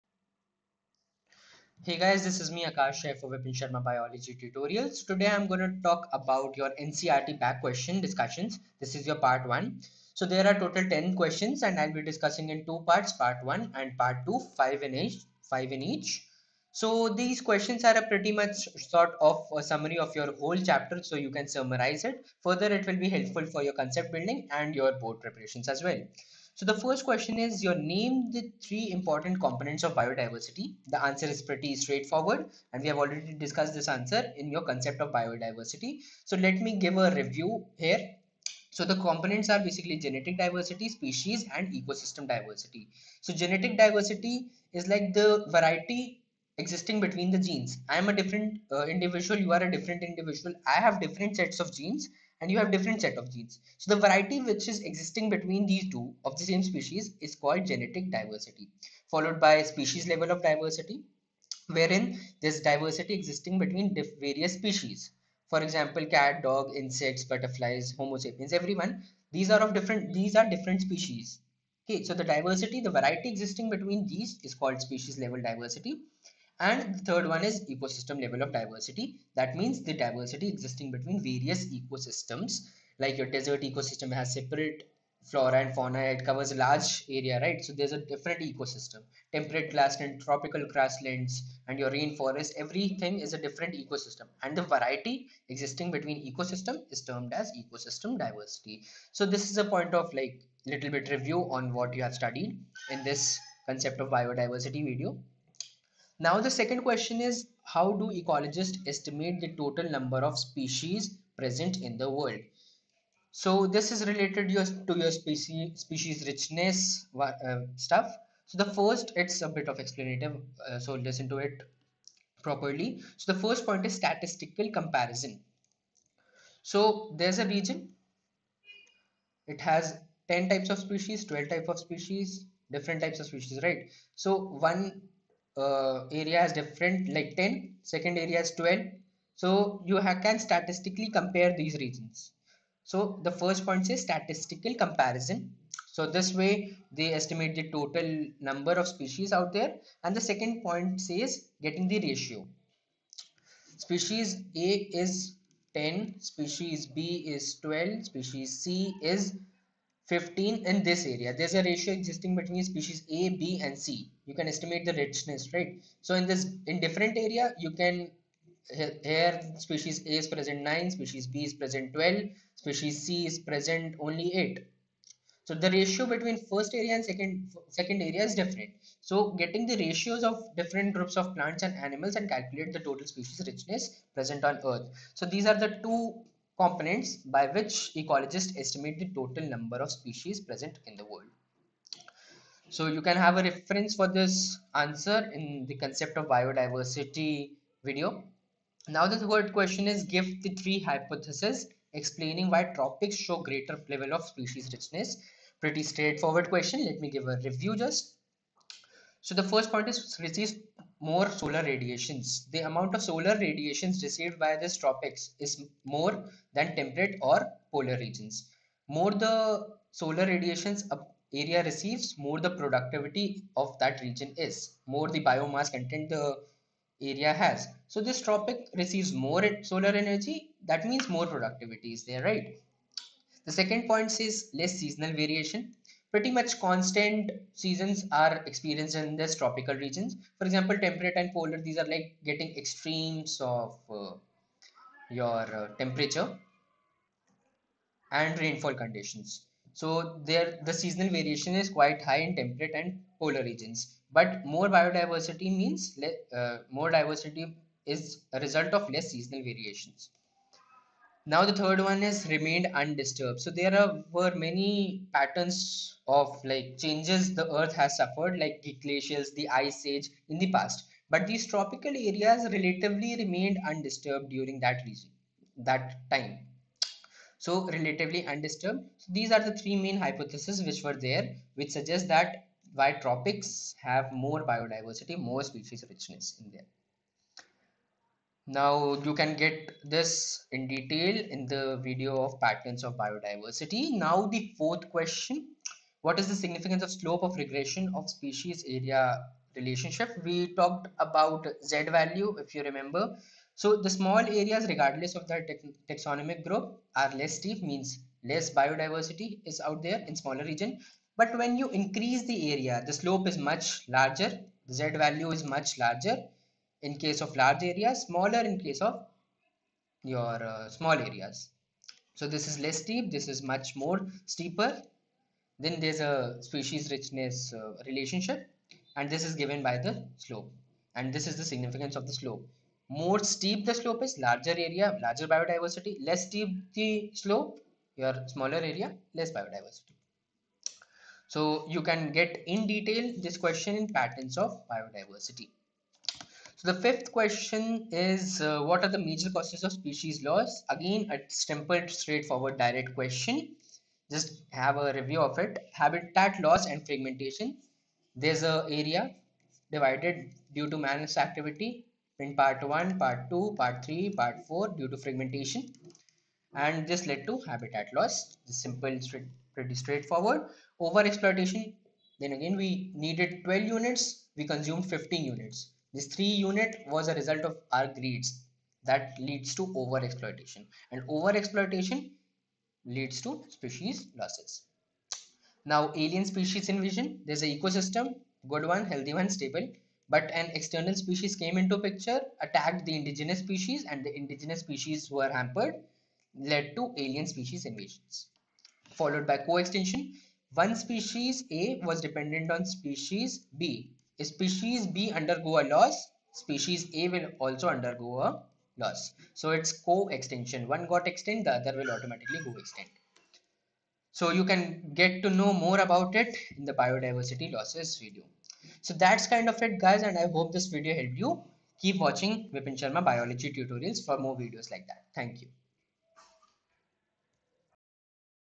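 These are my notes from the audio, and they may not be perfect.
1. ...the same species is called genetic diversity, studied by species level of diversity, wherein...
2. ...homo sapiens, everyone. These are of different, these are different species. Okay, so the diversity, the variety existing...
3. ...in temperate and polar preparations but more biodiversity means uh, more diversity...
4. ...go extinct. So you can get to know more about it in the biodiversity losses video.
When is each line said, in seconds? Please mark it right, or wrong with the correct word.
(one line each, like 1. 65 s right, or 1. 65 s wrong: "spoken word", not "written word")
1. 56 s wrong: "followed", not "studied"
2. 67 s right
3. 252 s wrong: "regions", not "preparations"
4. 412 s right.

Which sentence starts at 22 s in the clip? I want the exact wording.
Further it will be helpful for your concept building and your board preparations as well.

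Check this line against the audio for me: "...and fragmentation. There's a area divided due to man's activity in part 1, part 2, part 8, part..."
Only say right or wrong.
wrong.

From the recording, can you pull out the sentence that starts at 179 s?
So getting the ratios of different groups of plants and animals and calculate the total species richness present on earth.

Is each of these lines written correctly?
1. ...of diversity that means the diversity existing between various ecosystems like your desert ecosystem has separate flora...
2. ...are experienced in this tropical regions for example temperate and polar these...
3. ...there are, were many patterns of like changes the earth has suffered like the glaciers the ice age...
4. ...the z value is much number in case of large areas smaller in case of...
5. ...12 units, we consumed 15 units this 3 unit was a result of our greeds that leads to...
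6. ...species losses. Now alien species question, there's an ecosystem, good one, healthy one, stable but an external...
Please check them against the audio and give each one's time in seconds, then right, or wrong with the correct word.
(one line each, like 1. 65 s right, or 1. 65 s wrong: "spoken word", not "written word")
1. 78 s right
2. 238 s right
3. 263 s right
4. 314 s wrong: "larger", not "number"
5. 373 s right
6. 383 s wrong: "invasion", not "question".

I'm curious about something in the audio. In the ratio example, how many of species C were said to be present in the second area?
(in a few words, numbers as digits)
8.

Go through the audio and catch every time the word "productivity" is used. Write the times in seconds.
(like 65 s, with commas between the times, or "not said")
222 s, 231 s.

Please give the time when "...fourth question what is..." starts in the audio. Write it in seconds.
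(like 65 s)
294 s.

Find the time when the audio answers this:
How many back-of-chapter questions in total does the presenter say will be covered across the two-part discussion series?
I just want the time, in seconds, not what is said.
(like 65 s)
10 s.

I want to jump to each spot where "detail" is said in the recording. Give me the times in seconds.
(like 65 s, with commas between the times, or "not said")
290 s, 342 s.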